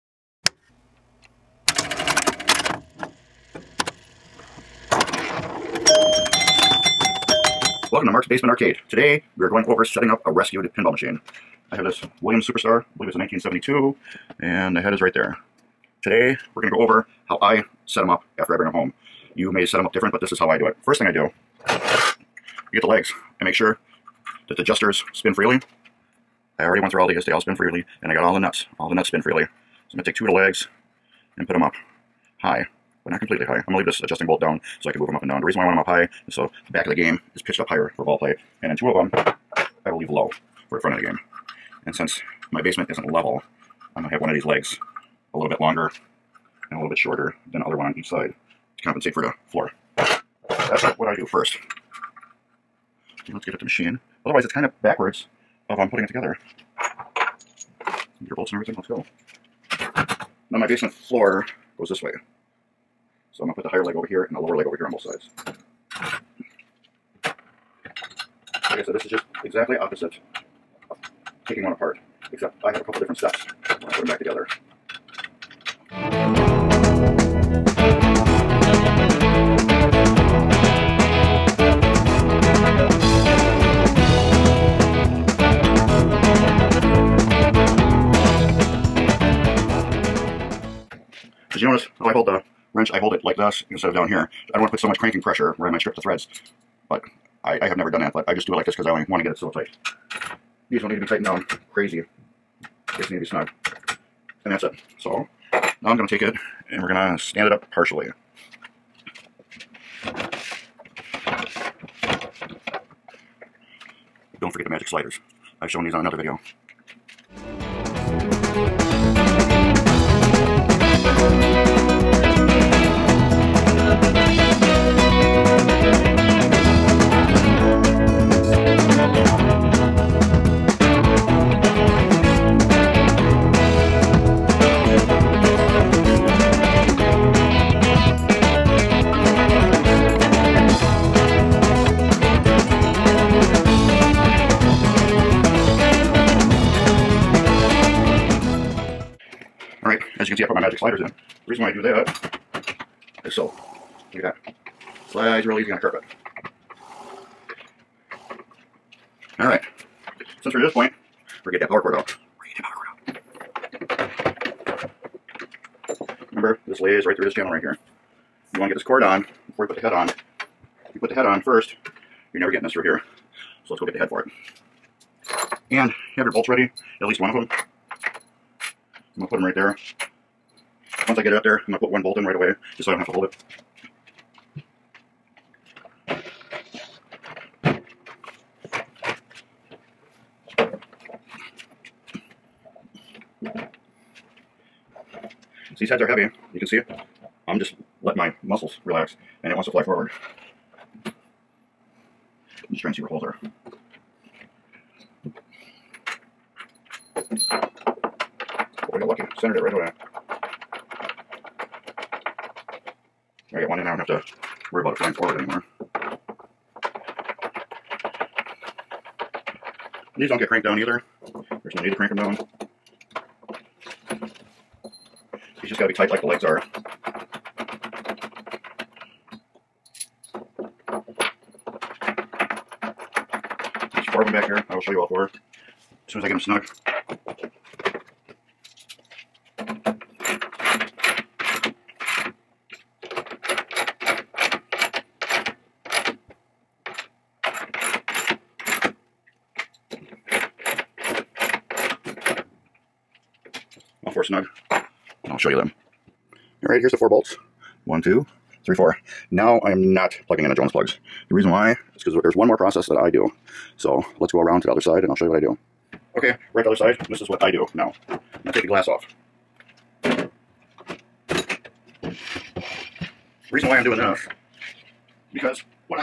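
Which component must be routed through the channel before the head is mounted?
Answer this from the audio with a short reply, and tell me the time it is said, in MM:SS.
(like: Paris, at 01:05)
power cord, at 02:41.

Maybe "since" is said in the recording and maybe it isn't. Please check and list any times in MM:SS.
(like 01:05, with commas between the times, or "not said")
00:41, 02:40.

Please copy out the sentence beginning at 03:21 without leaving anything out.
I'm just trying to see where holes are.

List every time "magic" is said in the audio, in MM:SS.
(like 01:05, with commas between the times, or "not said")
01:54, 02:30.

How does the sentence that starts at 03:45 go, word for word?
These just got to be tight like the legs are.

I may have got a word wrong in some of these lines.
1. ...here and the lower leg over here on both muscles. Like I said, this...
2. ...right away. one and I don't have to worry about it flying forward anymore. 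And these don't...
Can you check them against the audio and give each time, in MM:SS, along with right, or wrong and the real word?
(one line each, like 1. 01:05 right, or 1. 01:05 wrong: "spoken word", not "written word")
1. 01:04 wrong: "sides", not "muscles"
2. 03:29 right.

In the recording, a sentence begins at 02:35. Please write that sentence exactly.
Slides real easy on a carpet.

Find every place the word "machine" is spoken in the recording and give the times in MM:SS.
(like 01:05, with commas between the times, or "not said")
00:10, 00:53.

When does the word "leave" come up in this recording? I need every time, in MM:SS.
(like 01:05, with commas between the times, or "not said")
00:33, 00:39.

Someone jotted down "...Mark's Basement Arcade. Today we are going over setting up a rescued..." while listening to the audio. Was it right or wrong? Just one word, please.
right.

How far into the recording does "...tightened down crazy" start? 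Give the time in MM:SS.
01:41.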